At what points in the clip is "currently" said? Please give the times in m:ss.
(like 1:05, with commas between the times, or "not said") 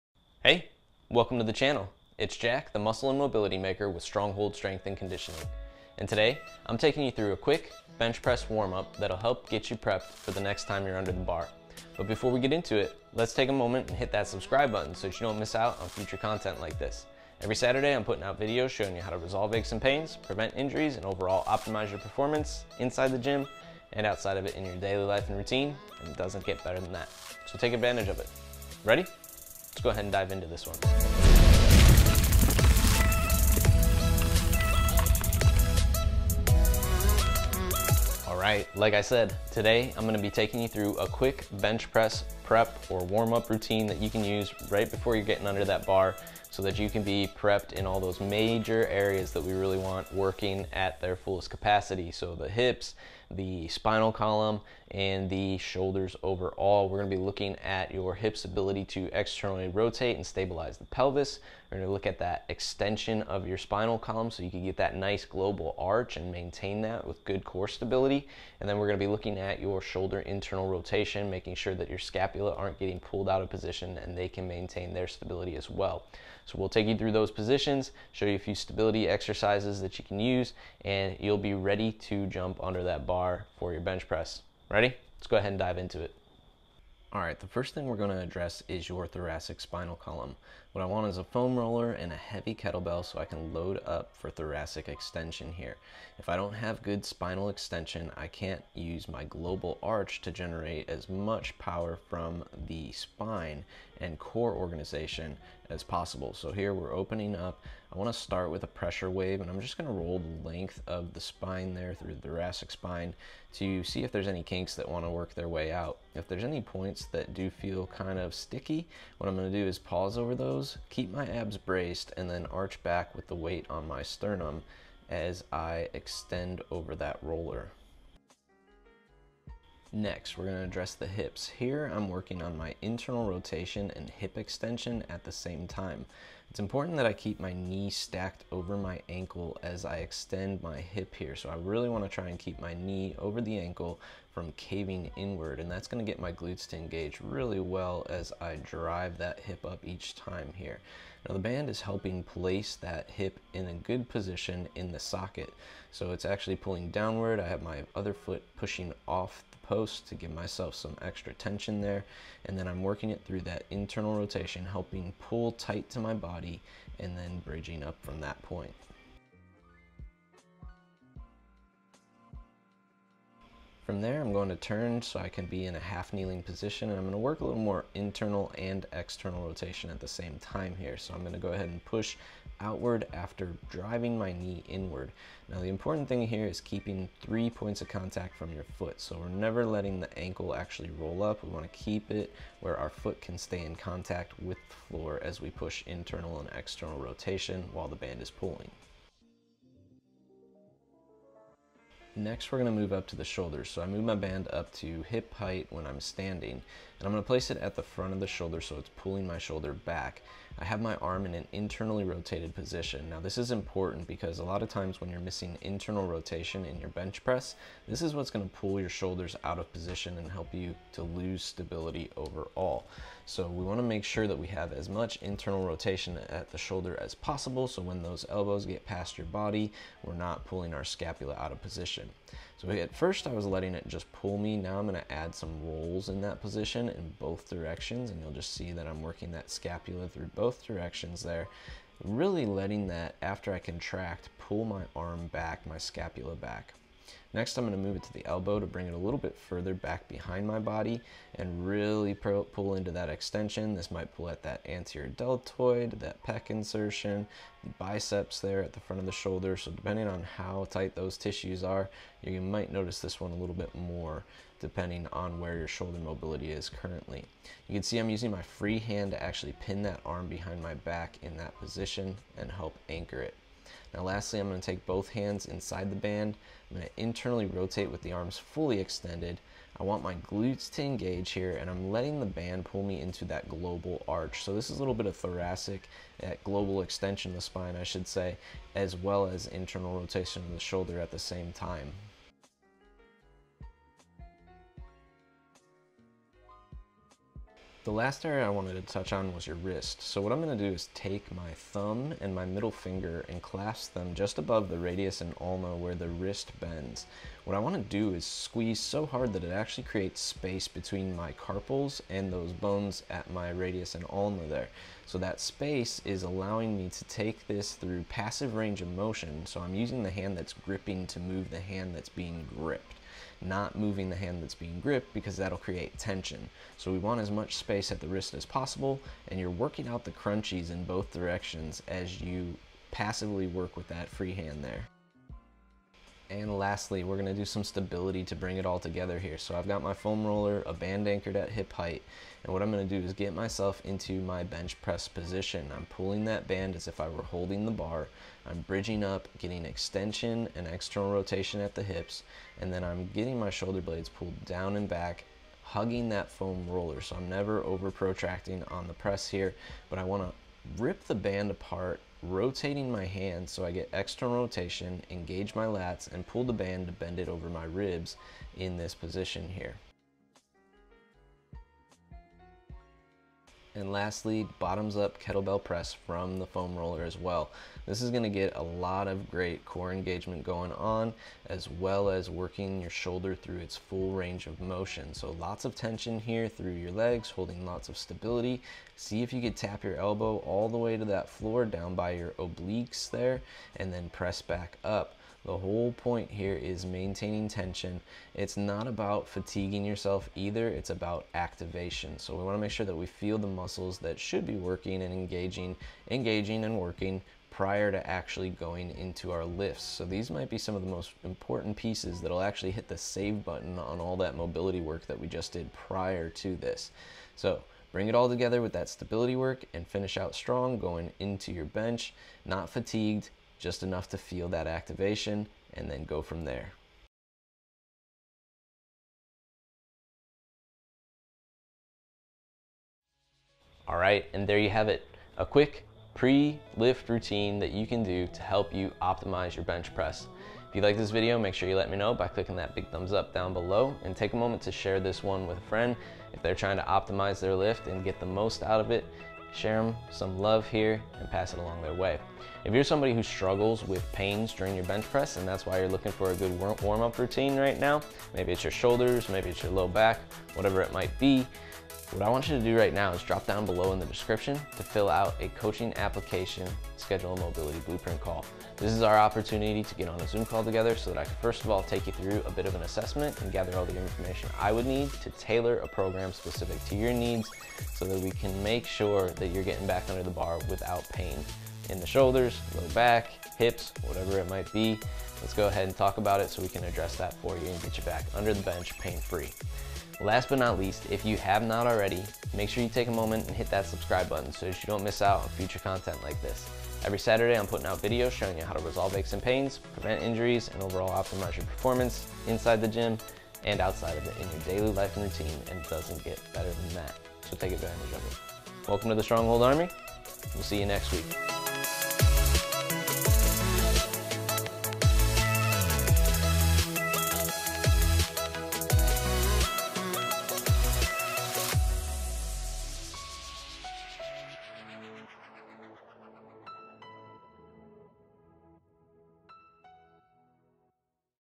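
4:26.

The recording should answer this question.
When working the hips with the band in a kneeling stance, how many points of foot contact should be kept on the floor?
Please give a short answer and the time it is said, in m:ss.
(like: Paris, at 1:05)
3, at 3:07.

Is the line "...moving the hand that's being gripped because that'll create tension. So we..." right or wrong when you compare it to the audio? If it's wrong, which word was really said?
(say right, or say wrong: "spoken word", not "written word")
right.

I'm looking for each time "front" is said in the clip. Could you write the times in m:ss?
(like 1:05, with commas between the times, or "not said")
3:27, 4:18.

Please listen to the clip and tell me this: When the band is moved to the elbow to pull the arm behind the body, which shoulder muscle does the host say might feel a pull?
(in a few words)
Anterior deltoid.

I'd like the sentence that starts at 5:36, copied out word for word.
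And lastly, we're gonna do some stability to bring it all together here.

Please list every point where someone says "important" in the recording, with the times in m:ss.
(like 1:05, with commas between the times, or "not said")
2:16, 3:05, 3:33, 6:51.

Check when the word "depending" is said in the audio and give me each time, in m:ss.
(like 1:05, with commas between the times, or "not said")
4:19, 4:24.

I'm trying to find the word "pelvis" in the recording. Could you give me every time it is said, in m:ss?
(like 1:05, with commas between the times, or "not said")
1:00.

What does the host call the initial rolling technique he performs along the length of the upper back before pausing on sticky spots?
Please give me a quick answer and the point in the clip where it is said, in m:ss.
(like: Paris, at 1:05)
Pressure wave, at 1:48.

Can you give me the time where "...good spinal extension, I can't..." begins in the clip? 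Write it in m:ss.
1:36.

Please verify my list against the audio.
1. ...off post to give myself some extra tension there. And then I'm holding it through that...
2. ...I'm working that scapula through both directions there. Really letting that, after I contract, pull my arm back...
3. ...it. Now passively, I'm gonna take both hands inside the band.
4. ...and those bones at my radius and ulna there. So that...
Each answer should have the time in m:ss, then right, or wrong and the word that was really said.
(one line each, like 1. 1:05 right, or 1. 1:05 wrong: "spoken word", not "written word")
1. 2:39 wrong: "working", not "holding"
2. 3:58 right
3. 4:33 wrong: "lastly", not "passively"
4. 5:12 right.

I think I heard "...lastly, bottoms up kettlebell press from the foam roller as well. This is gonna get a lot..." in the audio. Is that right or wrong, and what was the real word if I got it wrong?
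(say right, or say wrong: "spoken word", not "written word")
right.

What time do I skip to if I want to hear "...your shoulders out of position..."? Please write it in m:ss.
3:38.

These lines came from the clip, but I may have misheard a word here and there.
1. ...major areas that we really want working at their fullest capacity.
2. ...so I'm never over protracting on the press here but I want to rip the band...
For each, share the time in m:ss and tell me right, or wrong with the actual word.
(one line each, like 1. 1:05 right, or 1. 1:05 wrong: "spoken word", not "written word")
1. 0:48 right
2. 5:57 right.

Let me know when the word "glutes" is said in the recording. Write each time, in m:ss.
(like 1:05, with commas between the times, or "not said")
2:26, 4:40.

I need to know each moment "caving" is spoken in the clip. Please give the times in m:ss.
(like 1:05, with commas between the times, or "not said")
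2:24.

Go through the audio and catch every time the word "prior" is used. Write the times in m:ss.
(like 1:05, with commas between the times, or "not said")
6:47, 6:55.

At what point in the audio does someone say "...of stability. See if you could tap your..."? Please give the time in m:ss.
6:27.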